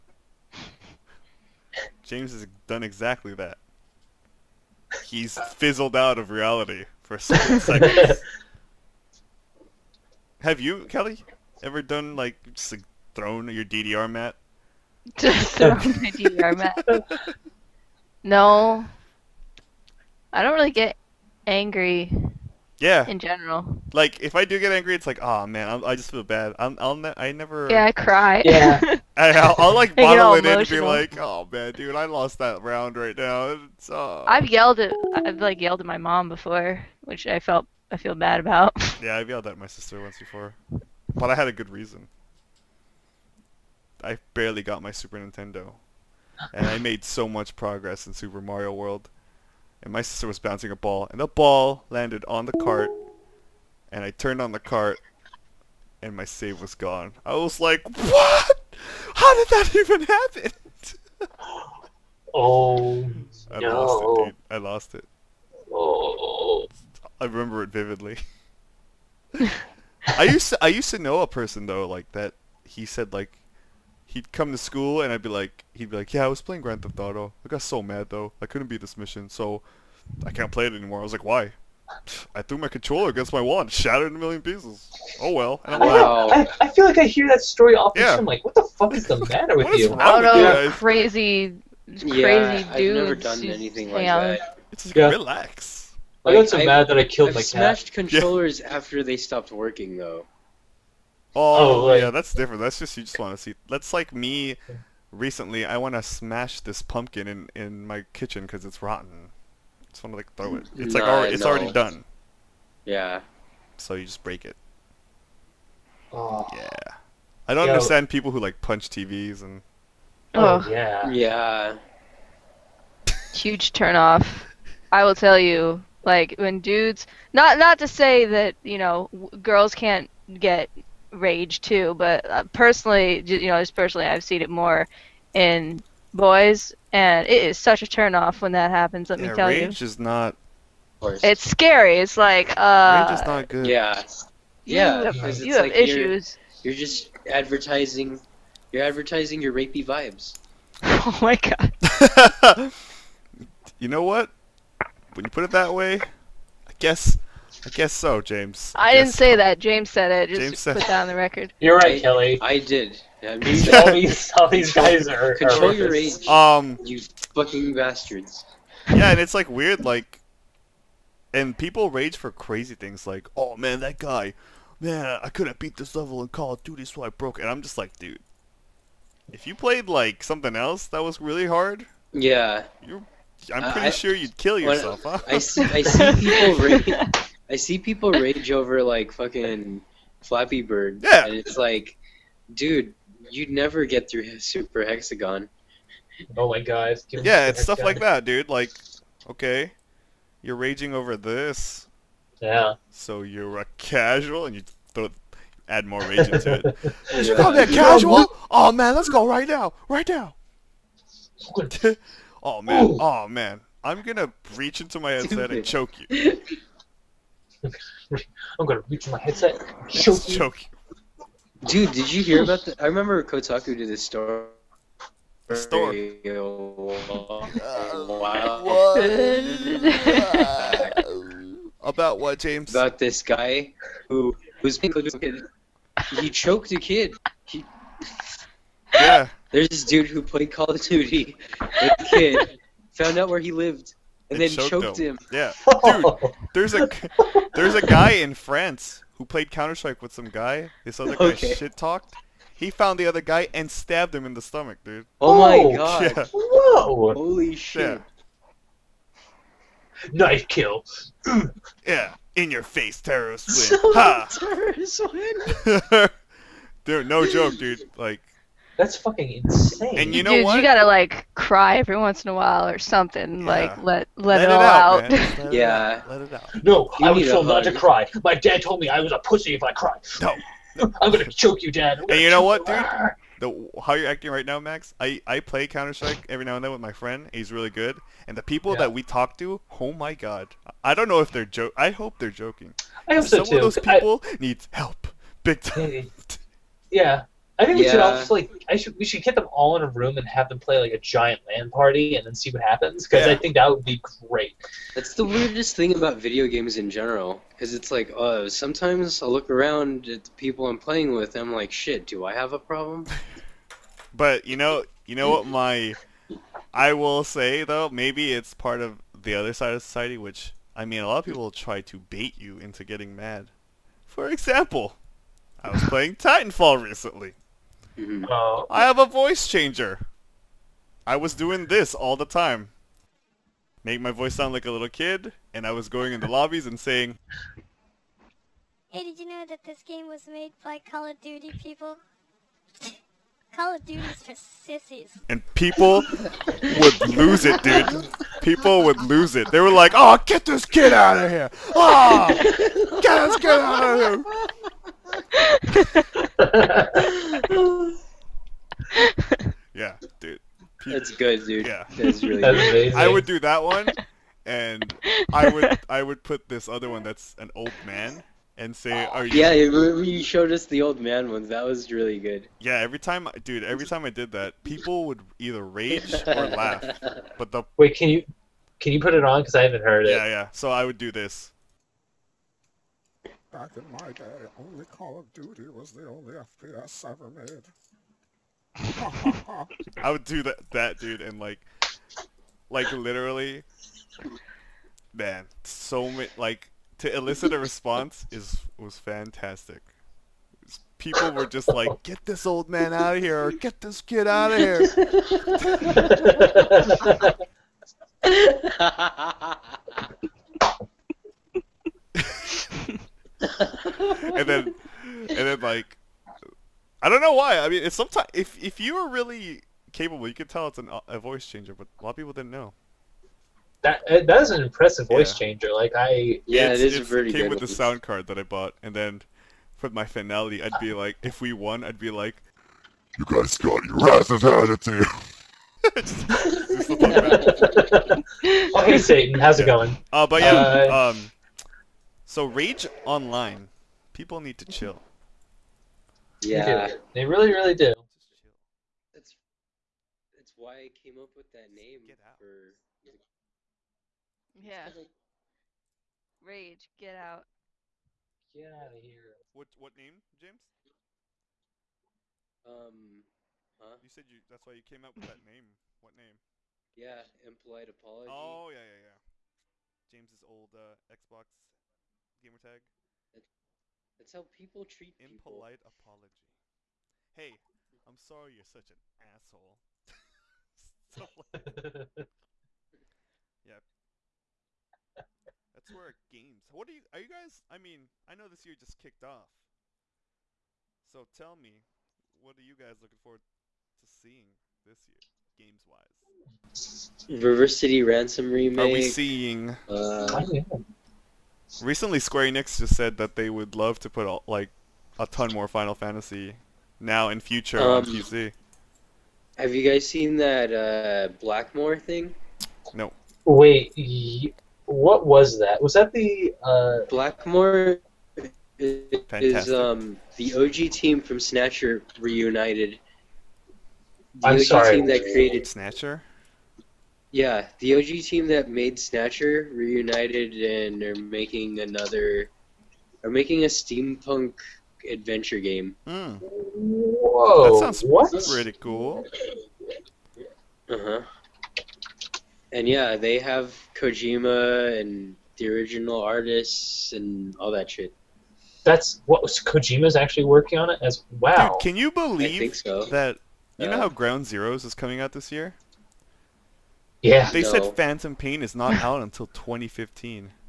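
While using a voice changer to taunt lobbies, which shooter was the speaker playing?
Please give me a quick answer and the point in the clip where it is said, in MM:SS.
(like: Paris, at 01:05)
Titanfall, at 05:26.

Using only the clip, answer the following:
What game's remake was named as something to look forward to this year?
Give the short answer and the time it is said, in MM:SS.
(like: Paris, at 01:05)
River City Ransom, at 08:17.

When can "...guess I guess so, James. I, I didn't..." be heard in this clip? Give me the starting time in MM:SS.
02:36.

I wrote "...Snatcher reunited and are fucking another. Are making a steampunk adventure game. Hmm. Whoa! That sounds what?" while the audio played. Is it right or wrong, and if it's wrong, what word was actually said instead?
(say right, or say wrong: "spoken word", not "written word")
wrong: "making", not "fucking".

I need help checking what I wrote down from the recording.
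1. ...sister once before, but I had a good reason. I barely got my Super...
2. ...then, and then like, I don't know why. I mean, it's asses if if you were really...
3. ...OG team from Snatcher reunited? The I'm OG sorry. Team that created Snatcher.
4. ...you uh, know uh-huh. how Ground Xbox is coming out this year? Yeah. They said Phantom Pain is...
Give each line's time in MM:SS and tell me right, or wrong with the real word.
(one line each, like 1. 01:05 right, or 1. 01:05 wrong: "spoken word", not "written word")
1. 00:39 right
2. 06:54 wrong: "sometimes", not "asses"
3. 08:40 right
4. 09:13 wrong: "Zeroes", not "Xbox".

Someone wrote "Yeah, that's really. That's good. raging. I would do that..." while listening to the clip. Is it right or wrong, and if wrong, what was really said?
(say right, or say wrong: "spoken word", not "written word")
wrong: "amazing", not "raging".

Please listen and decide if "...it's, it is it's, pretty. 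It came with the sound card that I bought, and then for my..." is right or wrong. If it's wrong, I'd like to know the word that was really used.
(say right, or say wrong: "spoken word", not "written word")
right.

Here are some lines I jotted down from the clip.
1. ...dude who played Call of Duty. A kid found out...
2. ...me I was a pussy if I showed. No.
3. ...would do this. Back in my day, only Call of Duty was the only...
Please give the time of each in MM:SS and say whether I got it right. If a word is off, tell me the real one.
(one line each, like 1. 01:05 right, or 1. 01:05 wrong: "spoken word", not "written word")
1. 03:59 right
2. 04:38 wrong: "cried", not "showed"
3. 06:20 right.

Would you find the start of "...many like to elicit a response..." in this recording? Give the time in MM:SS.
06:36.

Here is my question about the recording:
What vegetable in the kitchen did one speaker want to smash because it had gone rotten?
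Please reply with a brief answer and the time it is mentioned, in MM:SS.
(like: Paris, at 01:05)
Pumpkin, at 01:46.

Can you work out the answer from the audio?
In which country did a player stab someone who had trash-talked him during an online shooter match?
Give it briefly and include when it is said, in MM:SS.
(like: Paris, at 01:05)
France, at 04:08.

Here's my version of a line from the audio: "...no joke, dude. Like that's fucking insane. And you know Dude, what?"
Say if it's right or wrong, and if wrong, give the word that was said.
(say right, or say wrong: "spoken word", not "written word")
right.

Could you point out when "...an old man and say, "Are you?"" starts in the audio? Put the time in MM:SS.
06:07.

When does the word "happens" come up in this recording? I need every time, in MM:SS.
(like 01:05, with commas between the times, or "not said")
01:00, 02:18, 05:02.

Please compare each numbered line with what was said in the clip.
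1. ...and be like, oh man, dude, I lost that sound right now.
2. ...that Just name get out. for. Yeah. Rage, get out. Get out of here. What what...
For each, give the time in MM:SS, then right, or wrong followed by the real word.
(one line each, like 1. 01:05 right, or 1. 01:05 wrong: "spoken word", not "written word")
1. 00:30 wrong: "round", not "sound"
2. 07:31 right.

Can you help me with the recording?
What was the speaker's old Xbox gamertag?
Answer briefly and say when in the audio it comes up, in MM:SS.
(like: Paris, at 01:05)
Impolite Apology, at 07:47.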